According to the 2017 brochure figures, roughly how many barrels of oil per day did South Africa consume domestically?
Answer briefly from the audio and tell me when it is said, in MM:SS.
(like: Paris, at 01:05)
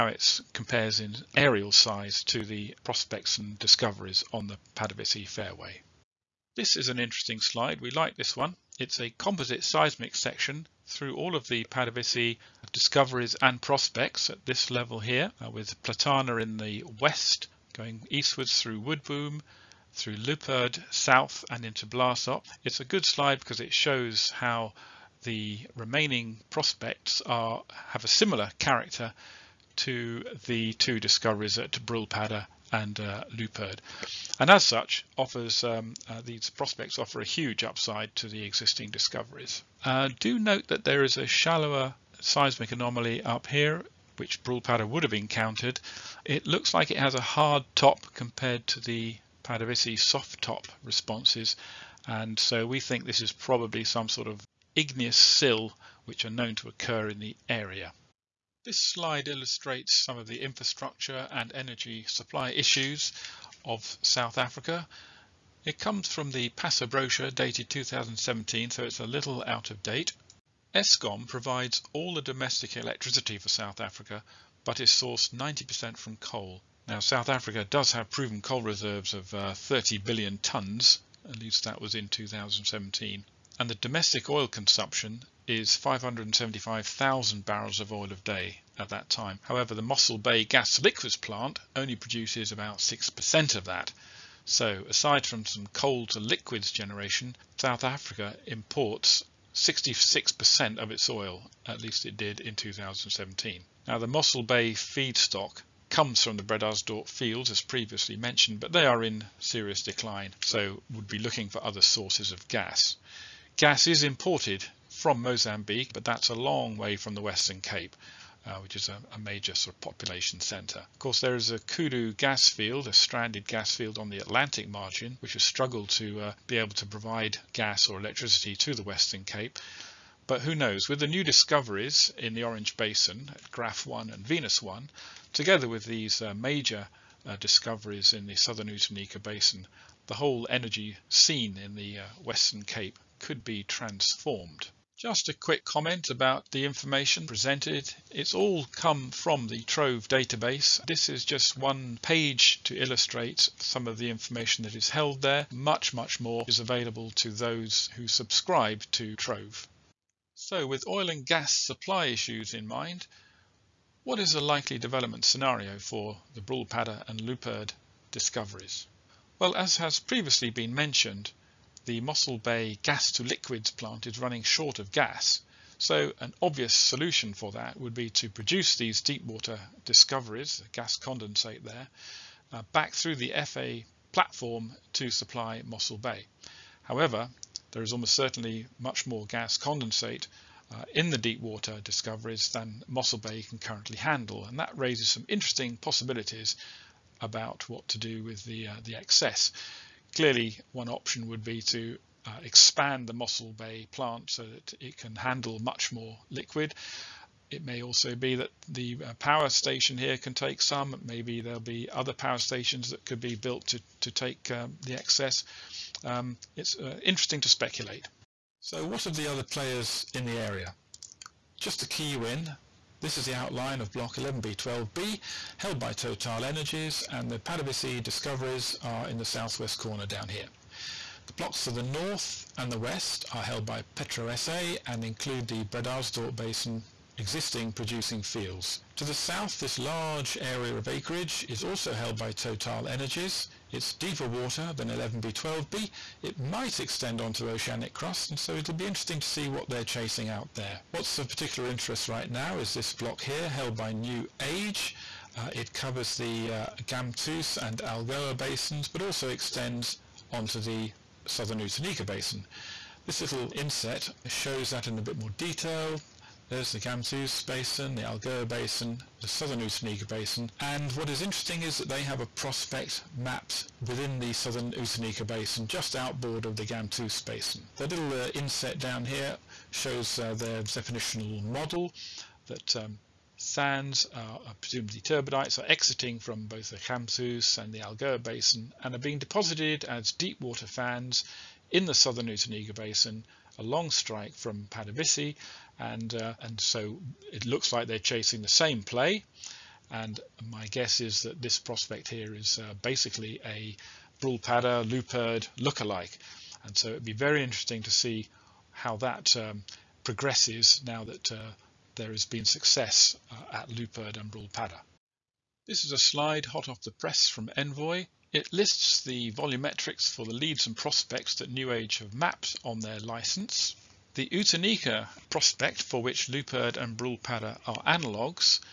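575,000, at 01:25.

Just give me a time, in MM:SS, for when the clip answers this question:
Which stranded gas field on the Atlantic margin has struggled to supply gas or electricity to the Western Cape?
02:01.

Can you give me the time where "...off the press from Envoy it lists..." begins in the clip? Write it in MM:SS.
05:16.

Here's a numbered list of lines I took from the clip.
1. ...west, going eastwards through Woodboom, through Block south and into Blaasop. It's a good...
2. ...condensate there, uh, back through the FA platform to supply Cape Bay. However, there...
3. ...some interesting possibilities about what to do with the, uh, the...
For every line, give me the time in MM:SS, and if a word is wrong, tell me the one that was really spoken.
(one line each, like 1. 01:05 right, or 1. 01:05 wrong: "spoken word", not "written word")
1. 00:16 wrong: "Luiperd", not "Block"
2. 03:00 wrong: "Mossel", not "Cape"
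3. 03:15 right.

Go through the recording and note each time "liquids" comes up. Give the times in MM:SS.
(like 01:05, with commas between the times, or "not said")
01:30, 01:36, 02:53, 03:26.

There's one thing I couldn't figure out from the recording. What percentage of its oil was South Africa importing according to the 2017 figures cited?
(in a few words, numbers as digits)
66%.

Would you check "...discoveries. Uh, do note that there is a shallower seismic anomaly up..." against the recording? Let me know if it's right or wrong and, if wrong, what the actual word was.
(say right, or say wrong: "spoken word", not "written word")
right.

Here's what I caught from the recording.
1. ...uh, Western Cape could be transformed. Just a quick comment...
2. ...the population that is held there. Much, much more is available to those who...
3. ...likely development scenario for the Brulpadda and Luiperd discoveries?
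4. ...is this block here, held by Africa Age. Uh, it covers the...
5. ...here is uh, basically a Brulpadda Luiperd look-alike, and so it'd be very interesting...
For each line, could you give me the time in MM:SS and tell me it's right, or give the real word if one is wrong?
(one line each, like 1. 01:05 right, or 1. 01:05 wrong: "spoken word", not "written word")
1. 02:21 right
2. 02:33 wrong: "information", not "population"
3. 02:44 right
4. 04:12 wrong: "New", not "Africa"
5. 05:02 right.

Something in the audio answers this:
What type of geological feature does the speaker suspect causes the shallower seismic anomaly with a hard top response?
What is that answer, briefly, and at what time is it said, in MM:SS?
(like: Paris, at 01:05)
Igneous sill, at 00:54.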